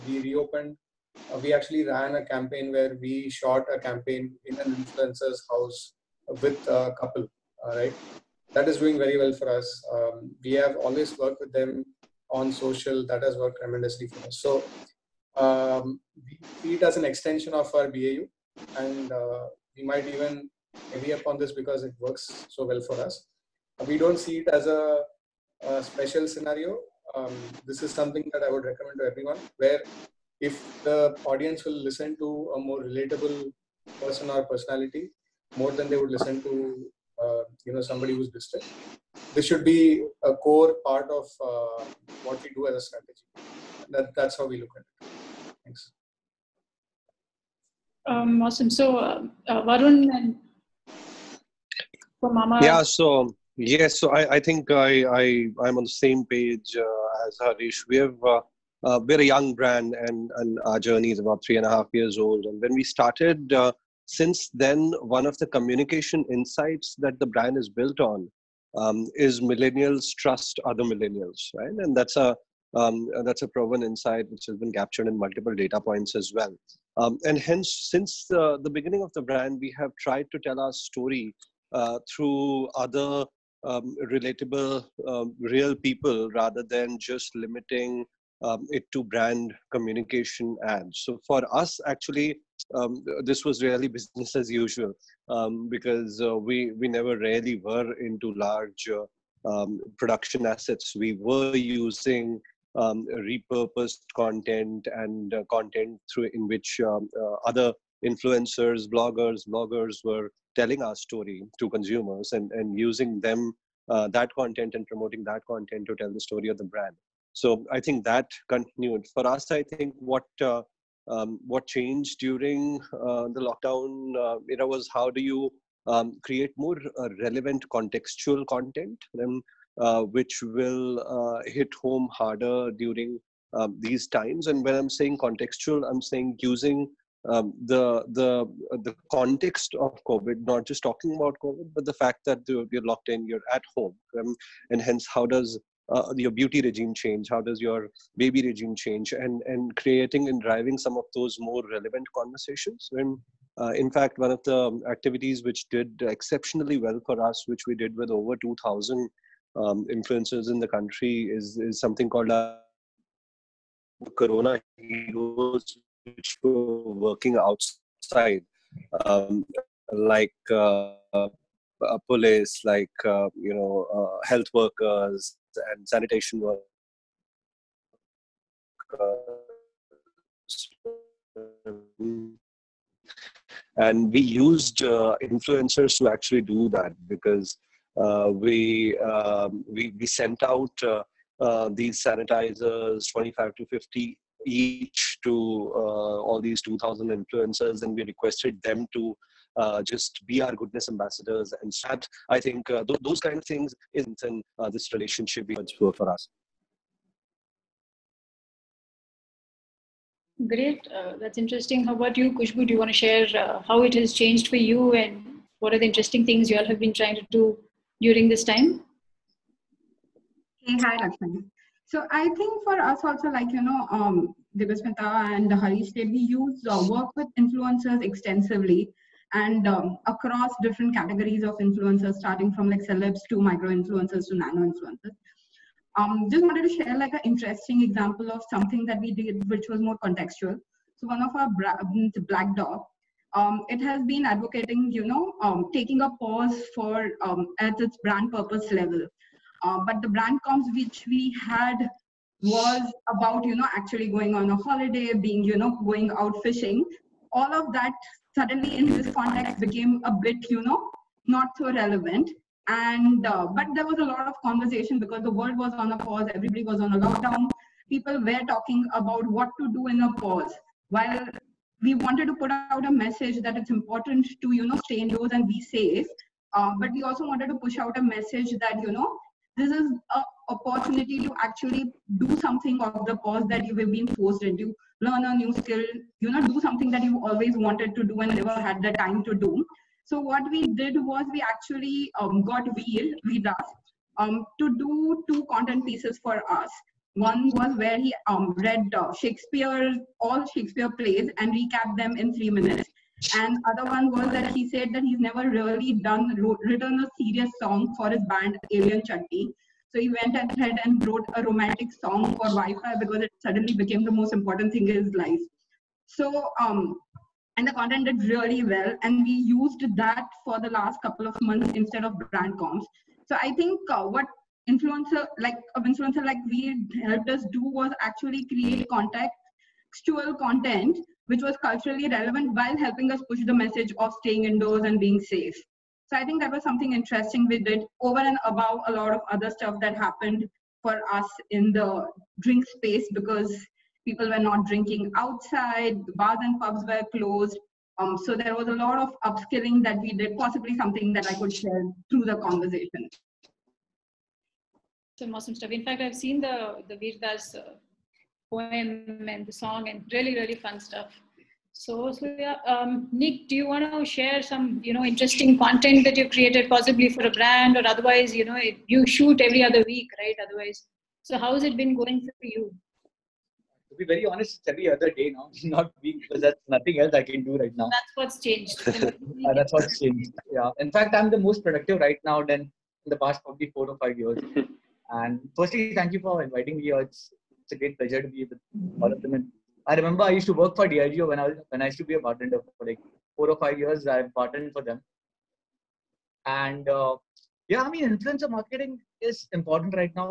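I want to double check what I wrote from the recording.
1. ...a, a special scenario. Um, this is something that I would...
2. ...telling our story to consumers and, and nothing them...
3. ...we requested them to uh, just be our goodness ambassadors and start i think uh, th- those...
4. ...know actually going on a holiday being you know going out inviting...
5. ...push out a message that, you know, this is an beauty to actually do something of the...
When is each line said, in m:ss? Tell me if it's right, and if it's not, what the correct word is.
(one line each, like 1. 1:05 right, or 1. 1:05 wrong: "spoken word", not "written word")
1. 0:24 right
2. 1:50 wrong: "using", not "nothing"
3. 3:17 right
4. 4:13 wrong: "fishing", not "inviting"
5. 4:37 wrong: "opportunity", not "beauty".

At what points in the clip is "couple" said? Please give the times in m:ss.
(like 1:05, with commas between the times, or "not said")
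0:06, 5:21.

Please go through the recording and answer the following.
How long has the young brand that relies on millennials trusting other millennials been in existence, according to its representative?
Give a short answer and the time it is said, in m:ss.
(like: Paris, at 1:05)
3.5 years, at 1:01.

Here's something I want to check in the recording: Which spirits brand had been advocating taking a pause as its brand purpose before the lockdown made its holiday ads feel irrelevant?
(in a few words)
Black Dog.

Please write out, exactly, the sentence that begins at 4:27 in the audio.
People were talking about what to do in a pause.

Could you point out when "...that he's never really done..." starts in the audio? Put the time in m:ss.
5:04.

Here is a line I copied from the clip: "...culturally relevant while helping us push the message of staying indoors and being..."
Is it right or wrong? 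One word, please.
right.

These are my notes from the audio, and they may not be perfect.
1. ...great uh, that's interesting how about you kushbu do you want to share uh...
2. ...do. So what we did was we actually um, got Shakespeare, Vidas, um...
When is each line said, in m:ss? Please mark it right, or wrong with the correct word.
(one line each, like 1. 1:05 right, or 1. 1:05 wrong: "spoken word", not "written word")
1. 3:30 right
2. 4:49 wrong: "Veer", not "Shakespeare".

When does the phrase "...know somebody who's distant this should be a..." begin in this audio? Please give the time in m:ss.
0:37.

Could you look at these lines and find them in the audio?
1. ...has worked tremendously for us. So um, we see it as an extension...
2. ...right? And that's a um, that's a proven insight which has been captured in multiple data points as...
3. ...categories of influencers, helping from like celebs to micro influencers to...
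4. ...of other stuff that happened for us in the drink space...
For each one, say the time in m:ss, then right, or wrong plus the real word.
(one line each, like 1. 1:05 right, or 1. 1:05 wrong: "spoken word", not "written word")
1. 0:13 right
2. 1:11 right
3. 3:50 wrong: "starting", not "helping"
4. 5:39 right.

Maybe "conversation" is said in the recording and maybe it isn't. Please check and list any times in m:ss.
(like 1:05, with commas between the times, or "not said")
2:32, 4:24, 5:52.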